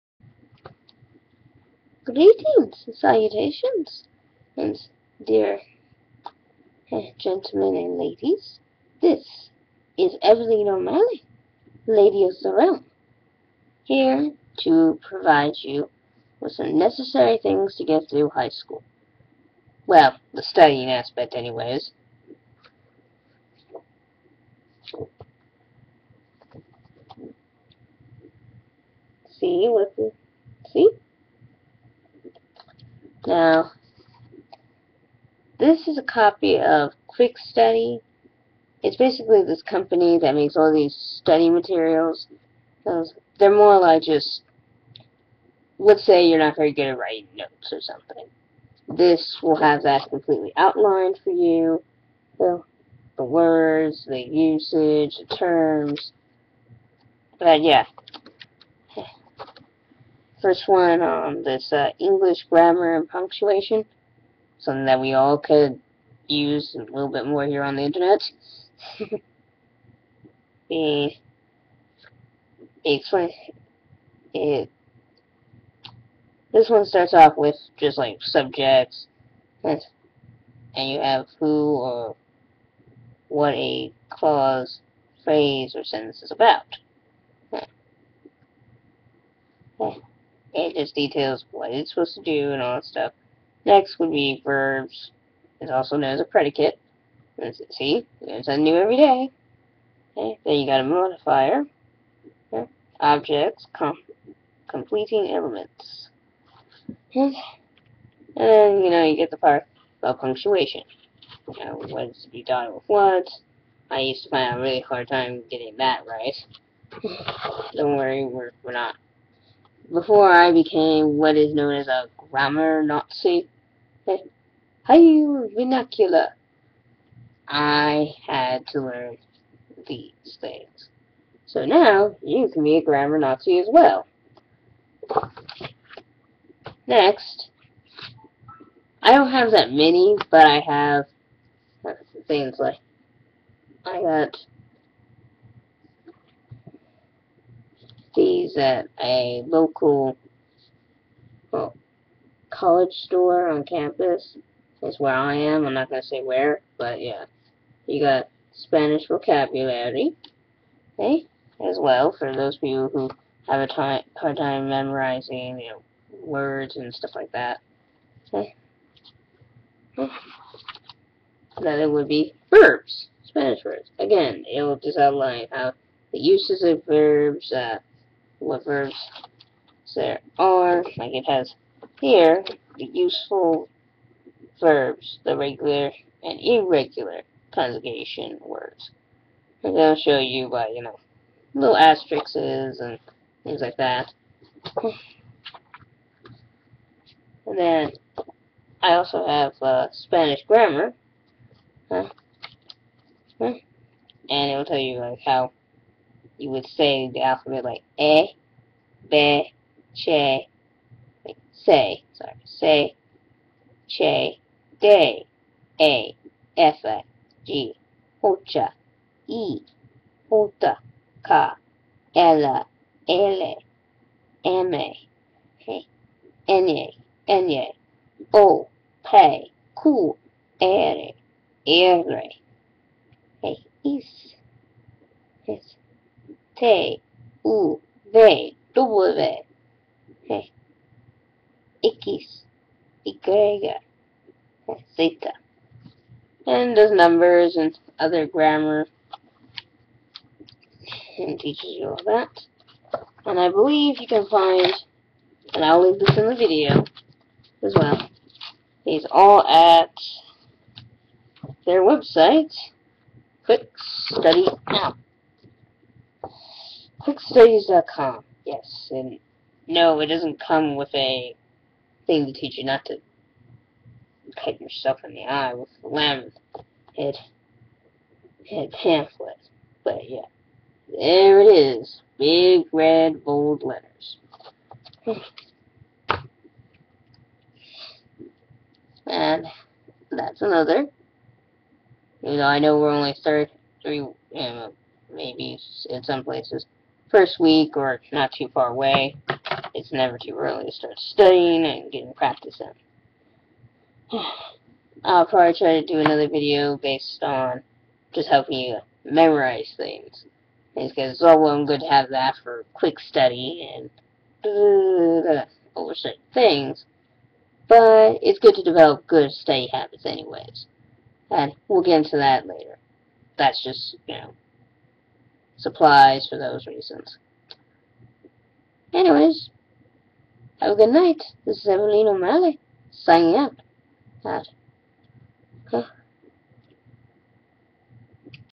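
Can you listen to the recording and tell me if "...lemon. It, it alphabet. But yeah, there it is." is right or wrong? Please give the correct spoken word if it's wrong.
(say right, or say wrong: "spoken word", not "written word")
wrong: "pamphlet", not "alphabet".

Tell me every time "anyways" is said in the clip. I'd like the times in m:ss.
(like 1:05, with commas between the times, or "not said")
0:21, 5:20, 5:28.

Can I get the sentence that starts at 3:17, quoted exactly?
And then I also have uh, Spanish grammar.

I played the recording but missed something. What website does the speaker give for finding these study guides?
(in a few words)
QuickStudies.com.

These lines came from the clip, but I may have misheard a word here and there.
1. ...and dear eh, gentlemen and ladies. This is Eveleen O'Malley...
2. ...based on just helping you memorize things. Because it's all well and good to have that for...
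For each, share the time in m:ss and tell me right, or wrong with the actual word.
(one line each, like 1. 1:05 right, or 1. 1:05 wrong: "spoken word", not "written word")
1. 0:04 right
2. 5:06 right.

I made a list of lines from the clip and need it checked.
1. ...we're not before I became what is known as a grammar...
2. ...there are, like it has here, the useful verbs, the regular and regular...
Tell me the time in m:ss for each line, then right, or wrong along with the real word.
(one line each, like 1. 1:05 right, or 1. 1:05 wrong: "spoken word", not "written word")
1. 1:58 right
2. 2:59 wrong: "irregular", not "regular".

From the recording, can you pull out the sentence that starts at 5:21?
And we'll get into that later.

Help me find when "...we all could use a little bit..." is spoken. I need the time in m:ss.
1:04.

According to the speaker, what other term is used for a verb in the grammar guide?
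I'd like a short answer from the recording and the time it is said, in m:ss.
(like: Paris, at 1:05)
predicate, at 1:36.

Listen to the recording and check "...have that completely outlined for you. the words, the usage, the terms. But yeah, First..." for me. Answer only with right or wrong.
right.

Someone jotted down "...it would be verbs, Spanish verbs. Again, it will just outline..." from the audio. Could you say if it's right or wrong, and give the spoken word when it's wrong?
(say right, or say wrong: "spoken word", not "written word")
right.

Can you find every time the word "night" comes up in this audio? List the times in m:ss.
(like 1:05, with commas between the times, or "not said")
5:30.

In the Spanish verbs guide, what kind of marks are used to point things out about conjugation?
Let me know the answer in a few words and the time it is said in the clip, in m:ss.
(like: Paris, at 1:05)
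asterisks, at 3:11.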